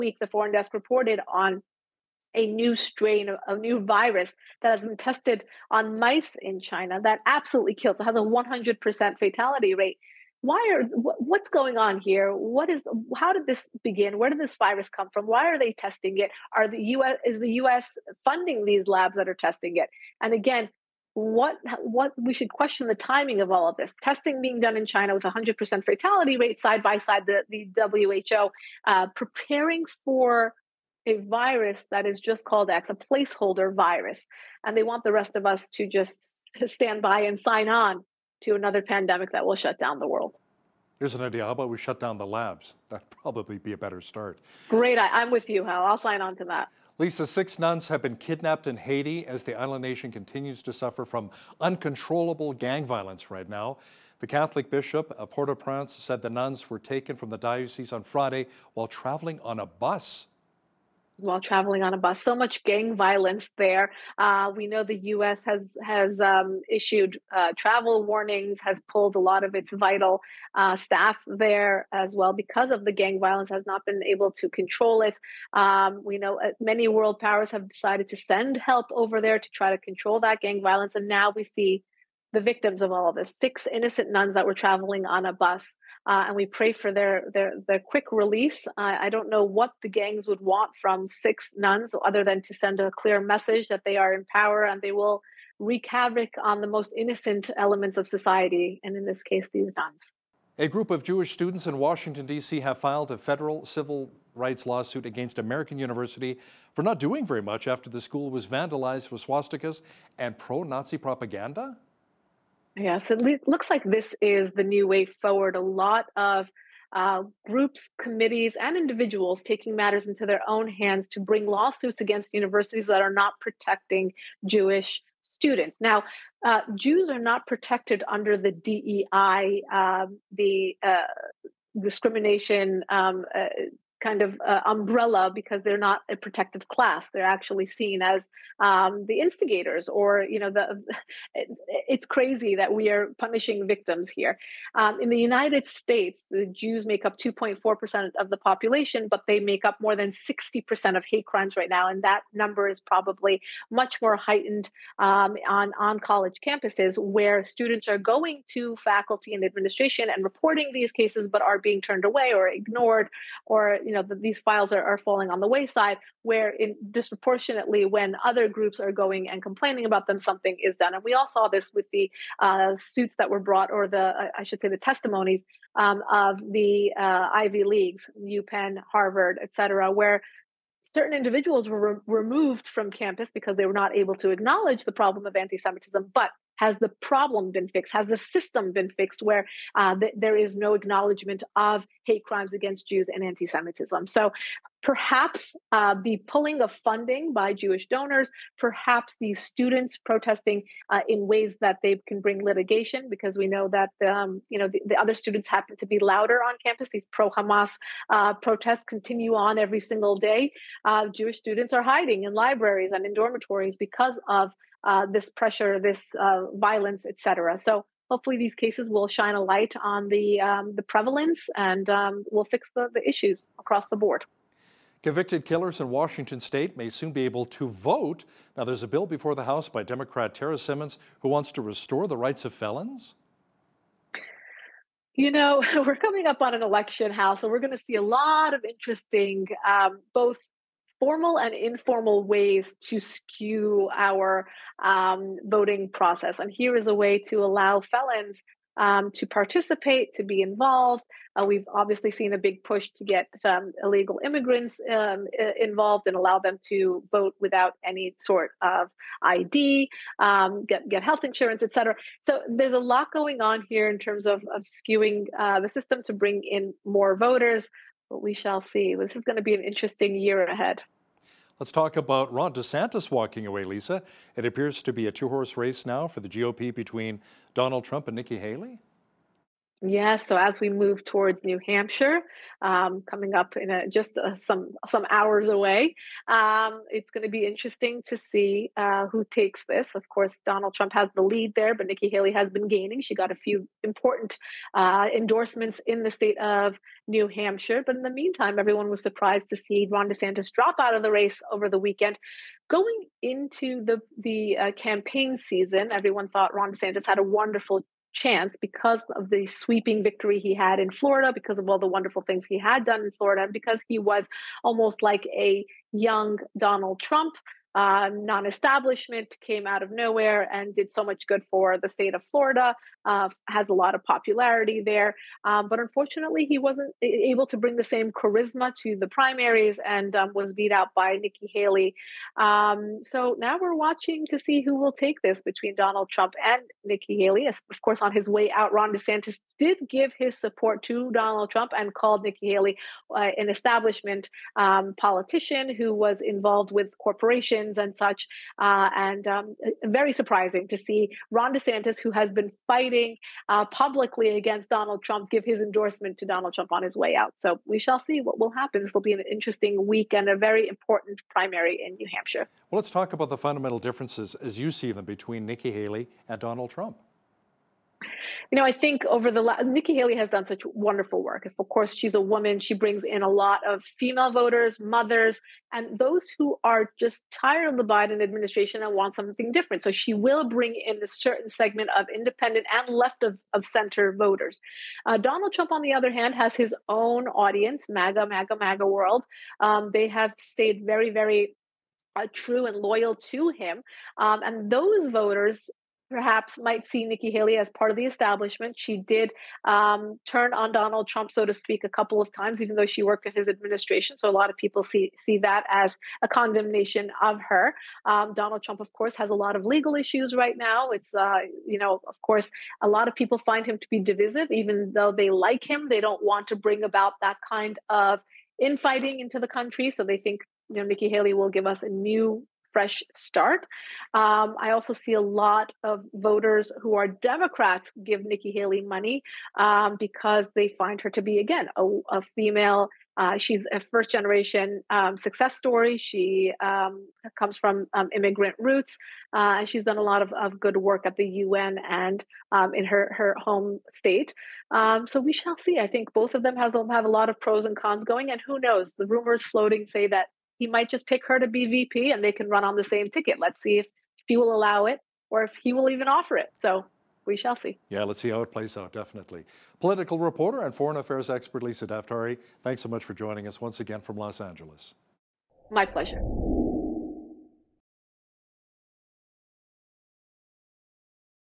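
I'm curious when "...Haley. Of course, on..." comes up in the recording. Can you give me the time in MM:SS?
05:37.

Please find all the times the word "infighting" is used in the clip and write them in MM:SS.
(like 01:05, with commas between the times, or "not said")
06:58.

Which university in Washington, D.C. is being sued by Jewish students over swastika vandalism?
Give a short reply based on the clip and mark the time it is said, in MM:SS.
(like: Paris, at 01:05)
American University, at 01:45.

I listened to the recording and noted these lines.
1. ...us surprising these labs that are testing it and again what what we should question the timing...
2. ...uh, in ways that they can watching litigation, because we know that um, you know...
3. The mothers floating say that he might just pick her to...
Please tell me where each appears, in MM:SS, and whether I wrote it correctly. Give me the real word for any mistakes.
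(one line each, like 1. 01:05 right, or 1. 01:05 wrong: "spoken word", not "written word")
1. 00:17 wrong: "funding", not "surprising"
2. 03:20 wrong: "bring", not "watching"
3. 07:28 wrong: "rumors", not "mothers".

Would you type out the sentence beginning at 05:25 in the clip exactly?
Um, but unfortunately, he wasn't able to bring the same charisma to the primaries and um, was beat out by Nikki Haley.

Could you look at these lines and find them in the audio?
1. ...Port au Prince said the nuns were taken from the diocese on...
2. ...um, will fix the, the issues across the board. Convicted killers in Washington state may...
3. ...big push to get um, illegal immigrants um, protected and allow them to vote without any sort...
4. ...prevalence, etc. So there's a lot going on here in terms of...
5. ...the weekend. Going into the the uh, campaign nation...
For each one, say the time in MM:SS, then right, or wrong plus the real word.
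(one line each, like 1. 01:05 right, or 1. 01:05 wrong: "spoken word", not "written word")
1. 00:55 right
2. 03:41 right
3. 04:12 wrong: "involved", not "protected"
4. 04:21 wrong: "insurance", not "prevalence"
5. 05:01 wrong: "season", not "nation".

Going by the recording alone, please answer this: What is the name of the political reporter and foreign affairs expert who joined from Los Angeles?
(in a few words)
Lisa Daftari.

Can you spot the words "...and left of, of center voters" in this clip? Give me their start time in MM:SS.
06:22.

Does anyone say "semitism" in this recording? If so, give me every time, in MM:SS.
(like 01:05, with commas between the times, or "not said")
03:05, 03:13.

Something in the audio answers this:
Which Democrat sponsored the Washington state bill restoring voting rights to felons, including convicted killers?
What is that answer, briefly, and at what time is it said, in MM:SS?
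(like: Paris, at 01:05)
Tara Simmons, at 03:50.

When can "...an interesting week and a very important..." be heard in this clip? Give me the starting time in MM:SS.
05:59.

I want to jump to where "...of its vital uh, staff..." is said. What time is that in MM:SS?
01:09.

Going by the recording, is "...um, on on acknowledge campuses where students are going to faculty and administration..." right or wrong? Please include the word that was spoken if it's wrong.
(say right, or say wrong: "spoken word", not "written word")
wrong: "college", not "acknowledge".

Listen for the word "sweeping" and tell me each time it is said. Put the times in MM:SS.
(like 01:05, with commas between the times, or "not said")
05:09.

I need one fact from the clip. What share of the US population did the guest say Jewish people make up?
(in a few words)
2.4%.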